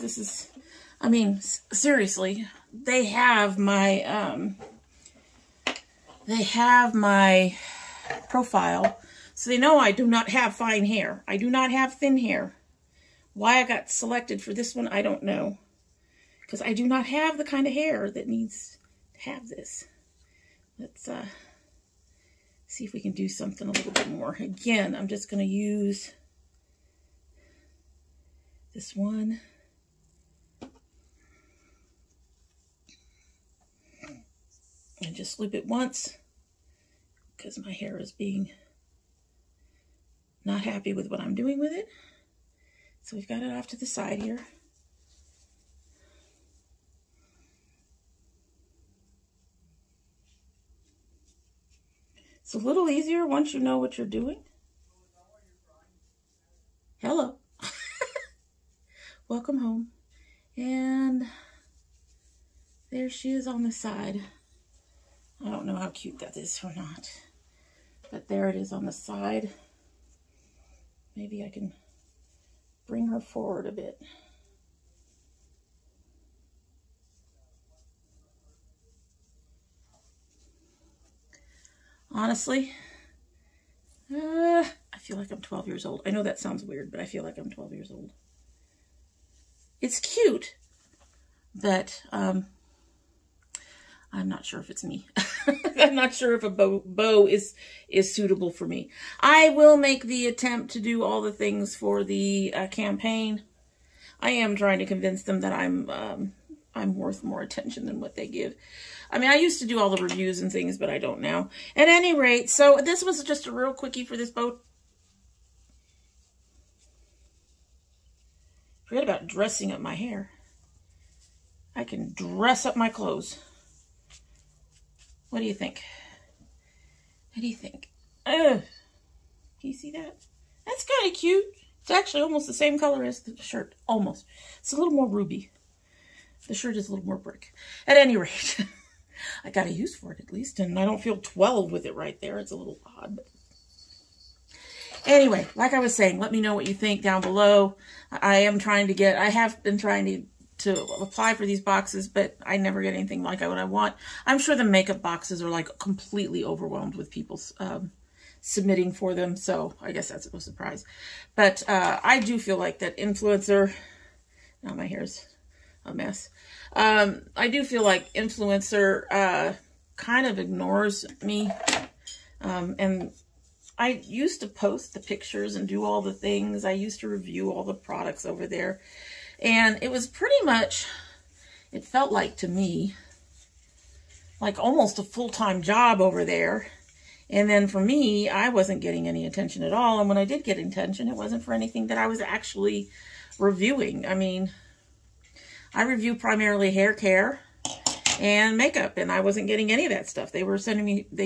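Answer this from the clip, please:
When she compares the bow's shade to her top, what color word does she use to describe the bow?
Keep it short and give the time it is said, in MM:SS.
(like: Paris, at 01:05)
ruby, at 02:15.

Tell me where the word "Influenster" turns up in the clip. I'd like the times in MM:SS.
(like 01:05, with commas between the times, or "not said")
02:42, 02:48.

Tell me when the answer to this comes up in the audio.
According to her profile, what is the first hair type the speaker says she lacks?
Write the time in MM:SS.
00:10.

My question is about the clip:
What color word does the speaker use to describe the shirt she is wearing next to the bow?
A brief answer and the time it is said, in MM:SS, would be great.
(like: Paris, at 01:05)
brick, at 02:17.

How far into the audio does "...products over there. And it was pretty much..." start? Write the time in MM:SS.
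02:57.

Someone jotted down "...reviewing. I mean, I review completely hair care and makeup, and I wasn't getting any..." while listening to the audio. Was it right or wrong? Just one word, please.
wrong.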